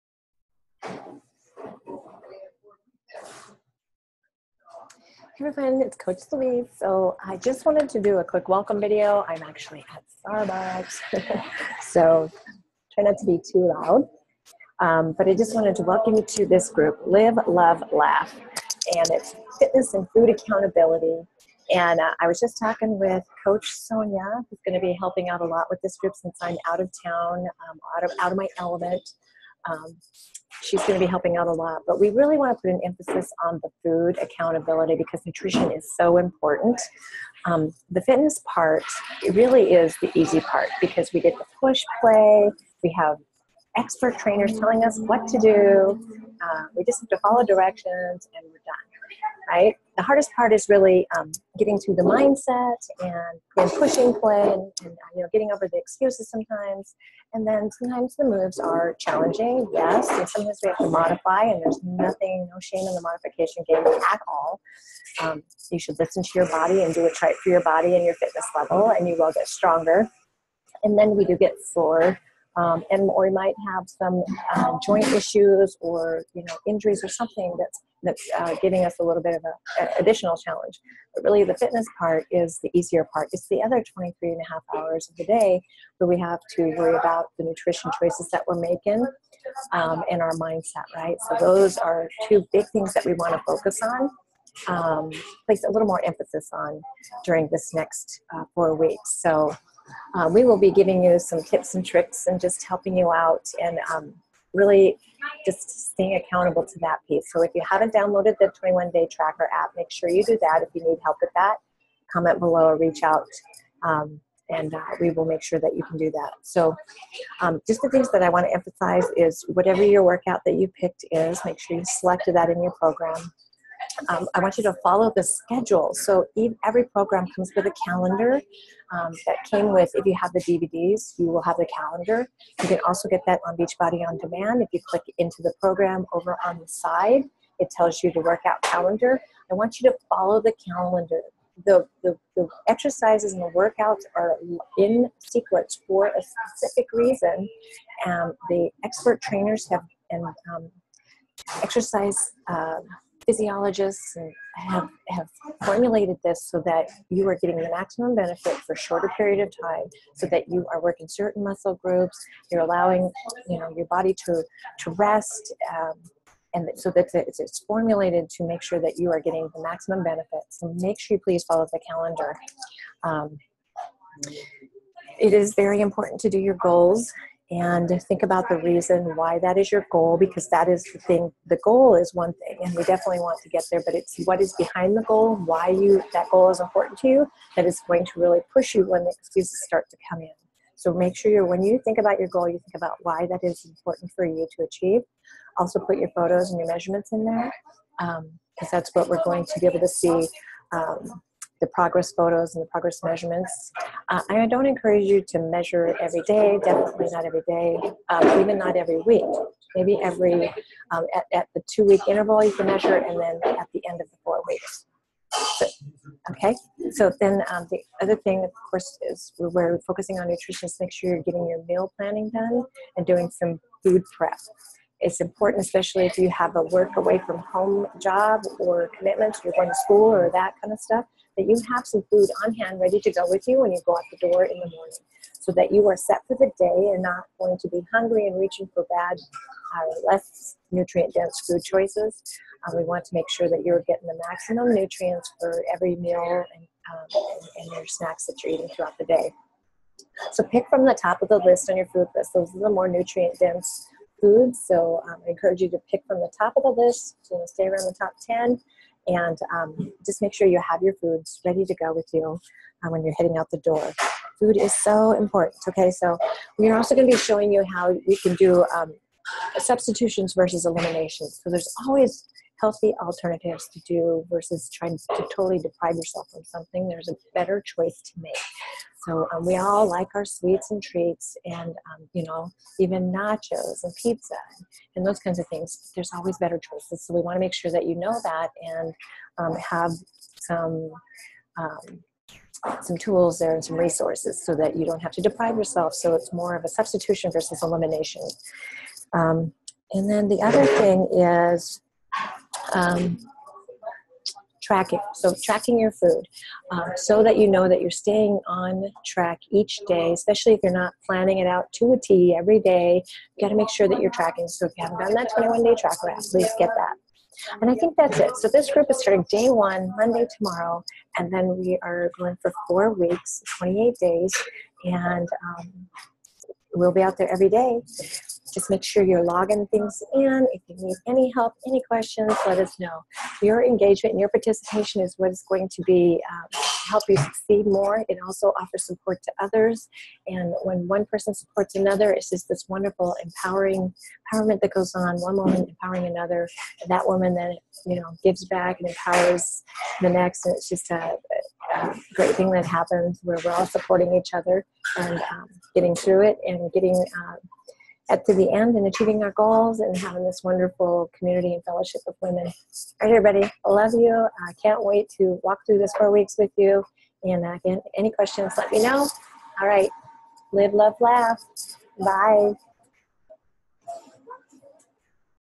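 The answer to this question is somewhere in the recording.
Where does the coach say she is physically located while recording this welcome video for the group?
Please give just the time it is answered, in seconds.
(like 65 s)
10 s.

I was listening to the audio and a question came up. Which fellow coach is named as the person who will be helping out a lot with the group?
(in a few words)
Coach Sonia.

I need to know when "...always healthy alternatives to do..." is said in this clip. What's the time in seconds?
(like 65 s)
271 s.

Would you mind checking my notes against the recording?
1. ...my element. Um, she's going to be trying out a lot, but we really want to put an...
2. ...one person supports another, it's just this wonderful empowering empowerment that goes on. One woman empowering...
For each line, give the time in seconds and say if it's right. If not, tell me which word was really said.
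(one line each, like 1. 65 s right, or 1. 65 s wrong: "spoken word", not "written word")
1. 28 s wrong: "helping", not "trying"
2. 340 s right.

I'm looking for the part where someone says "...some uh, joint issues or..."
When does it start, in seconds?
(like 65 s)
73 s.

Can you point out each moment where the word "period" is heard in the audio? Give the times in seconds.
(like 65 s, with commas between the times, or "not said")
159 s.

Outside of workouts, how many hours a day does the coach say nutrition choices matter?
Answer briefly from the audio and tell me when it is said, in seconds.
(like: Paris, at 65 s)
23 and a half, at 83 s.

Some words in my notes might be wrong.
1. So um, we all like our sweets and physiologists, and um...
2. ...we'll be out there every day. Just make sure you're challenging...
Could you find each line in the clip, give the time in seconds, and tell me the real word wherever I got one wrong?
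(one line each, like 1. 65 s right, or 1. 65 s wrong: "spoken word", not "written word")
1. 279 s wrong: "treats", not "physiologists"
2. 326 s wrong: "logging", not "challenging".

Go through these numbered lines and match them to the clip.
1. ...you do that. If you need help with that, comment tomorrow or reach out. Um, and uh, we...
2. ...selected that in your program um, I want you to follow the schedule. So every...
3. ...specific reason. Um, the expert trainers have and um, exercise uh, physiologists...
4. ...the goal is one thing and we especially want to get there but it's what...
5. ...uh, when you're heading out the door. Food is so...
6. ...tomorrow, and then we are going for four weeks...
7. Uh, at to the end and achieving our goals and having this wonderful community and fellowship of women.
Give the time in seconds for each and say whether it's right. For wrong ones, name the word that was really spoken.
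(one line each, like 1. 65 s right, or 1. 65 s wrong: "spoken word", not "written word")
1. 110 s wrong: "below", not "tomorrow"
2. 121 s right
3. 146 s right
4. 181 s wrong: "definitely", not "especially"
5. 262 s right
6. 320 s right
7. 357 s right.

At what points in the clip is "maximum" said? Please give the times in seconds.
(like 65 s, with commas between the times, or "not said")
157 s, 169 s, 244 s.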